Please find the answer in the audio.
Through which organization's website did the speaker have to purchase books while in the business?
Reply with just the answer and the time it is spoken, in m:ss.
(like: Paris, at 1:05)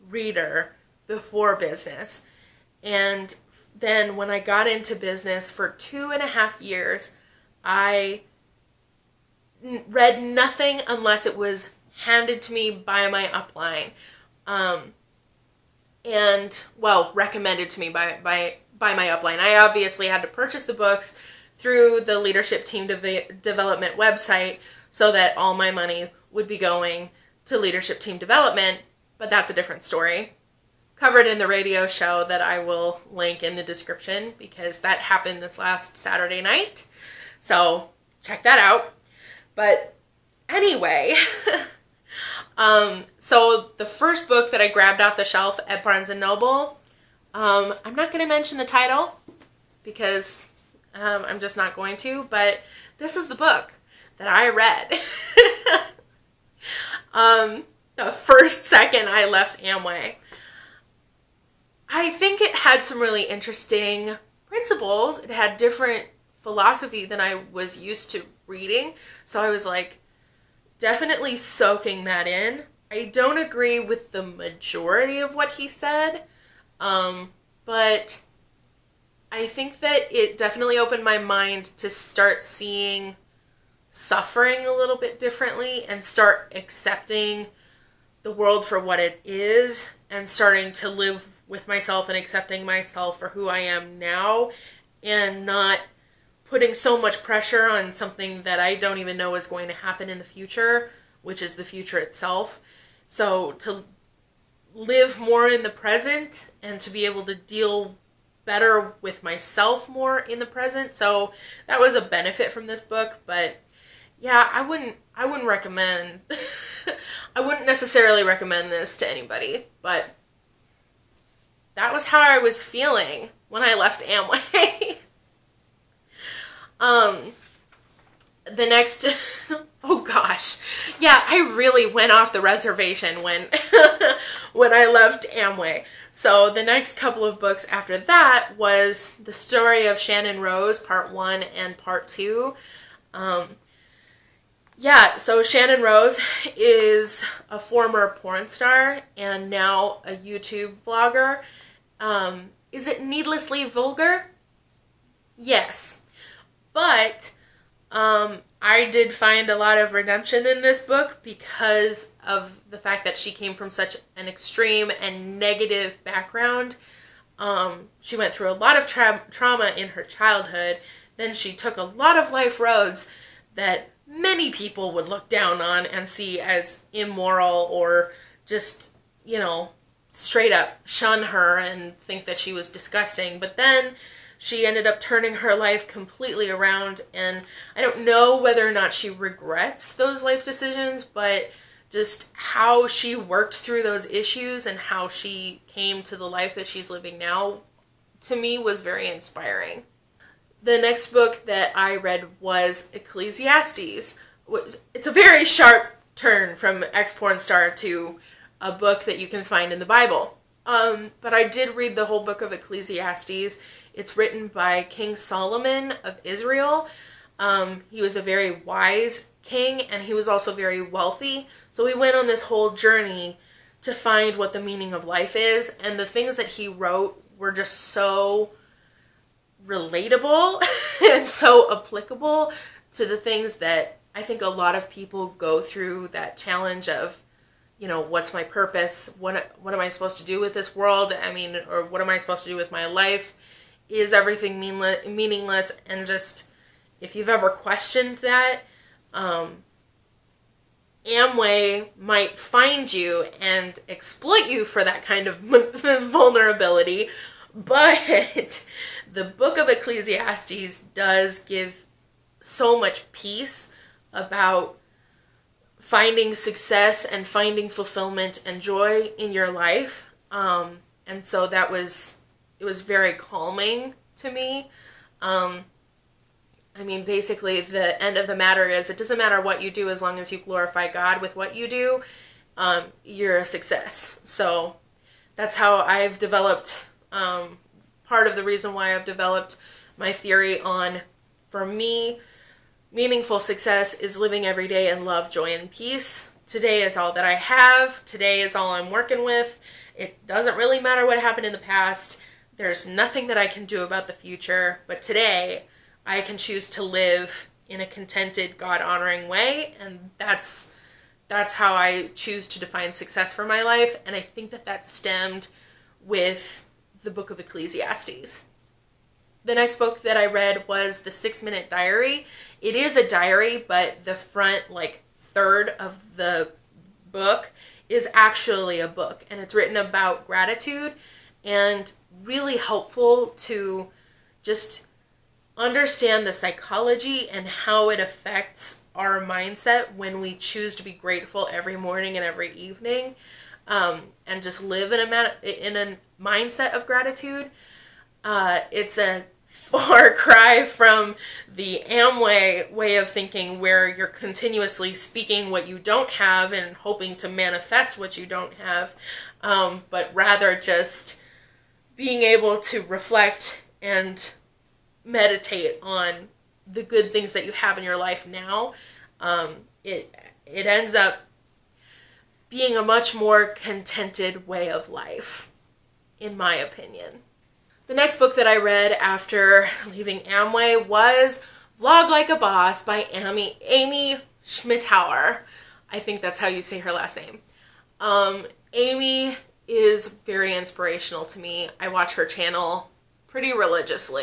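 Leadership Team Development, at 0:27.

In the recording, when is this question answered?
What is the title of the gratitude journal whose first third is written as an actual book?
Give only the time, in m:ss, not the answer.
5:21.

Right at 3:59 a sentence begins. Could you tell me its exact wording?
What what am I supposed to do with this world?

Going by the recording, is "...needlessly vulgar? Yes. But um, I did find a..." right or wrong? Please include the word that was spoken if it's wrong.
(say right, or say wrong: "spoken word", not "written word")
right.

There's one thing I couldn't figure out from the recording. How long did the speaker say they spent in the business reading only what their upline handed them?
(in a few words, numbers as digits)
2.5 years.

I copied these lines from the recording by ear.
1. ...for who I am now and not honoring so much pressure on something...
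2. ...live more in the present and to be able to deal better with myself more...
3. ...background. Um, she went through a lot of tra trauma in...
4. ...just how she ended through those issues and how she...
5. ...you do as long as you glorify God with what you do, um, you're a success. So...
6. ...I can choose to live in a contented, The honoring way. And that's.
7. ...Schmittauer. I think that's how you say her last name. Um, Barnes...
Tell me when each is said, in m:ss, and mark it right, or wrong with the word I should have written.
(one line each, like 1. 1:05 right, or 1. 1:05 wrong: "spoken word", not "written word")
1. 1:33 wrong: "putting", not "honoring"
2. 1:44 right
3. 2:46 right
4. 3:11 wrong: "worked", not "ended"
5. 4:39 right
6. 5:06 wrong: "God", not "The"
7. 6:24 wrong: "Amy", not "Barnes".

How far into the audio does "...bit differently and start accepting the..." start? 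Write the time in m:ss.
1:24.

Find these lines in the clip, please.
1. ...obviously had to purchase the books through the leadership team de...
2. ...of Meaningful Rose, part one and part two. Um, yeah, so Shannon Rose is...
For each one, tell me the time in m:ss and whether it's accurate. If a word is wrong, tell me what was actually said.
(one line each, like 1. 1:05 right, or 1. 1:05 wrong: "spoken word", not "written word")
1. 0:19 right
2. 2:19 wrong: "Shannon", not "Meaningful".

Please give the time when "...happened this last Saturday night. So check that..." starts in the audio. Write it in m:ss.
0:34.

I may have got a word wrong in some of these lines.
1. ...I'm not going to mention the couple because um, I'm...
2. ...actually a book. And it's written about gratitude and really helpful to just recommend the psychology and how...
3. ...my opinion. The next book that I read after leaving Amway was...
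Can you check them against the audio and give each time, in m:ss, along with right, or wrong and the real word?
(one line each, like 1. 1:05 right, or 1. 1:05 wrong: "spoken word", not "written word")
1. 0:47 wrong: "title", not "couple"
2. 5:28 wrong: "understand", not "recommend"
3. 6:16 right.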